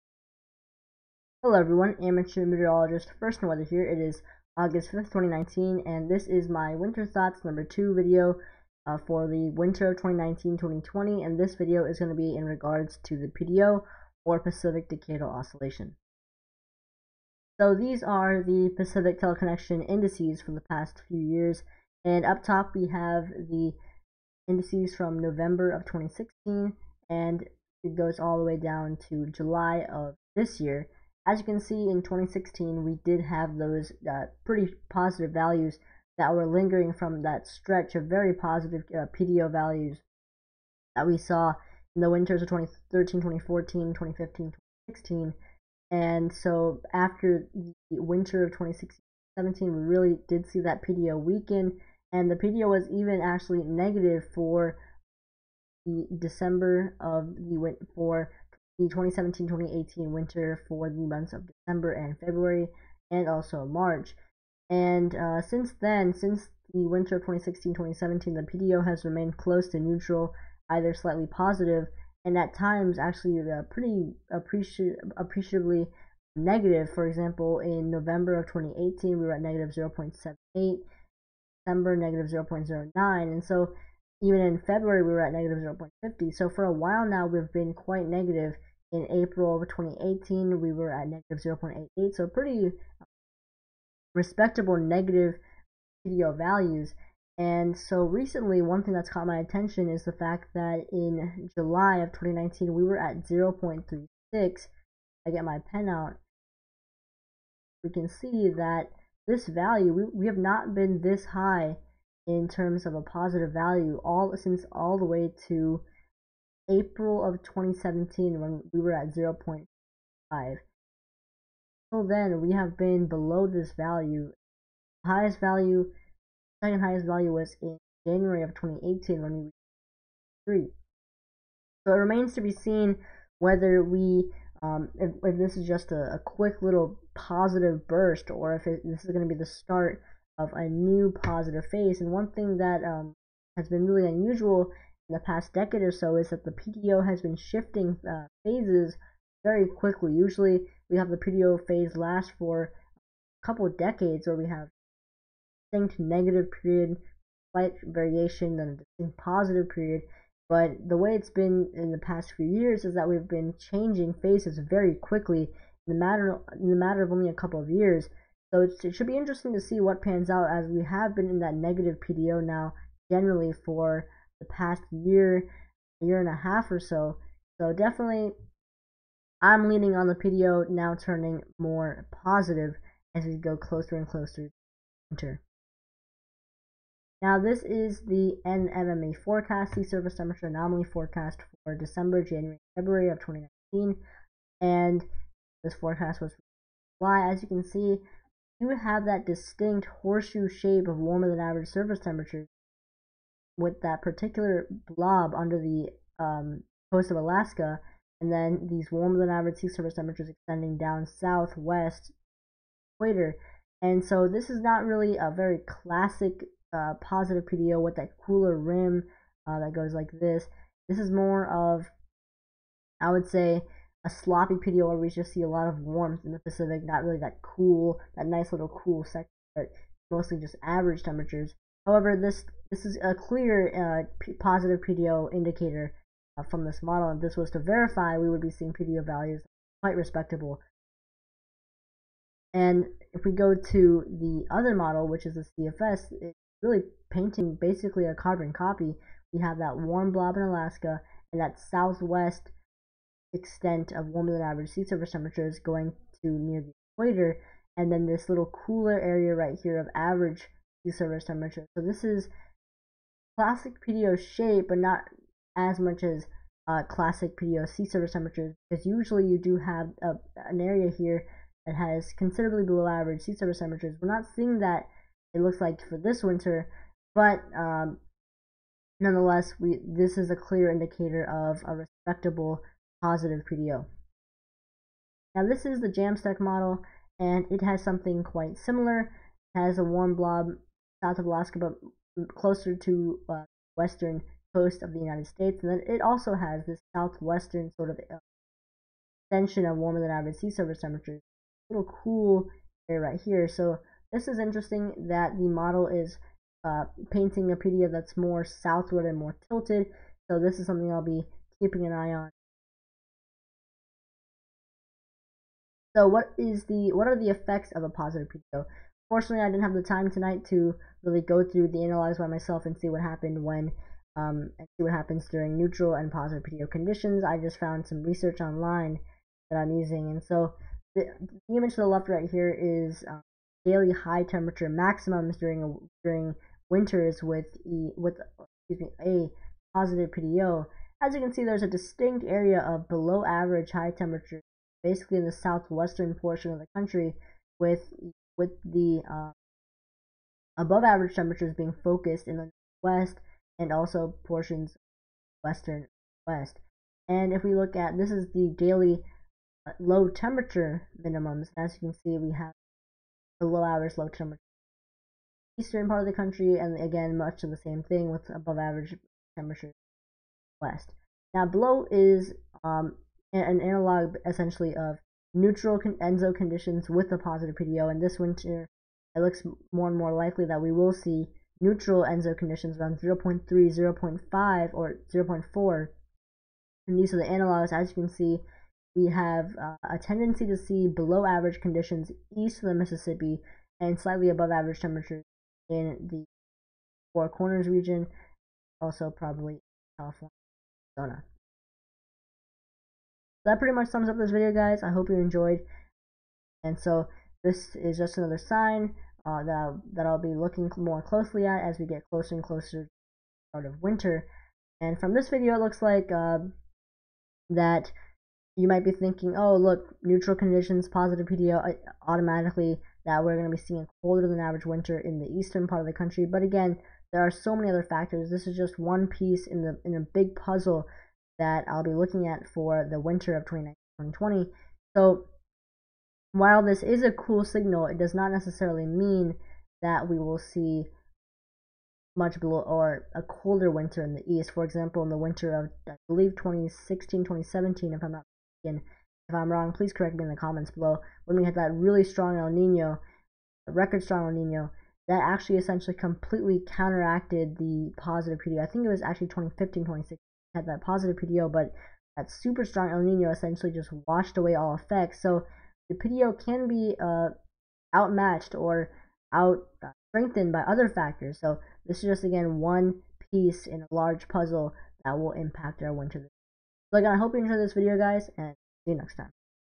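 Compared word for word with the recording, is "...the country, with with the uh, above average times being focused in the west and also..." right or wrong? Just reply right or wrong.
wrong.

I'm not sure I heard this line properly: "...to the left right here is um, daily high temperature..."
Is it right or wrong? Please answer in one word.
right.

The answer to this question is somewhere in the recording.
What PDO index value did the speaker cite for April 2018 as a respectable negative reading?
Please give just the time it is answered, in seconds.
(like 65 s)
91 s.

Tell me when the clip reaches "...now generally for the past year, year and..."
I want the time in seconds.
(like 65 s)
172 s.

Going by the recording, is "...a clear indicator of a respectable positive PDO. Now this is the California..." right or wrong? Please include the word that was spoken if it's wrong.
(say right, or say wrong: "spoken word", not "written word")
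wrong: "JAMSTEC", not "California".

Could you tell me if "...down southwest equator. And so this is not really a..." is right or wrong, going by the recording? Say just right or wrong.
right.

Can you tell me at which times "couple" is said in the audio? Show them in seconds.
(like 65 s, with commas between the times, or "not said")
153 s, 167 s.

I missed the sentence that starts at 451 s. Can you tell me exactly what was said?
When we had that really strong El Nino, record strong El Nino, that actually essentially completely counteracted the positive PD.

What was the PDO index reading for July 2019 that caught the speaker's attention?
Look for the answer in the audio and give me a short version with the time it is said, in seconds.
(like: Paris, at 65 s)
0.36, at 103 s.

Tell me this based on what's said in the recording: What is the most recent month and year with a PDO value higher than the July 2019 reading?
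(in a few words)
April 2017.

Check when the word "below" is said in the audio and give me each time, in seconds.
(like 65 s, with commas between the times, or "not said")
123 s, 272 s, 342 s, 371 s, 390 s, 442 s, 450 s.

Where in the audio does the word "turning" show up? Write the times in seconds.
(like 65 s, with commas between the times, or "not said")
180 s.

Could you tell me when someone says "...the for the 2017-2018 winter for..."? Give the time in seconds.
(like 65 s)
57 s.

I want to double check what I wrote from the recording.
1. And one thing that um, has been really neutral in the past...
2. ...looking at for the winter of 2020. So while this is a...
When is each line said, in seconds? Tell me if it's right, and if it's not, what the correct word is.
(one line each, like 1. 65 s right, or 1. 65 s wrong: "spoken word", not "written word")
1. 142 s wrong: "unusual", not "neutral"
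2. 431 s right.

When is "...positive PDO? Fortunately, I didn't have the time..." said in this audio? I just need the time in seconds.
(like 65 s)
317 s.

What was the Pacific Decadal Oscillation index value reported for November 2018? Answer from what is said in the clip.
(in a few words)
-0.78.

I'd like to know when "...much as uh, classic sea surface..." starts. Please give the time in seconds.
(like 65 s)
265 s.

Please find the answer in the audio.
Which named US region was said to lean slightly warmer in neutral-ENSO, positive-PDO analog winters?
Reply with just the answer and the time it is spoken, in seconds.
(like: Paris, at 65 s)
Four Corners, at 397 s.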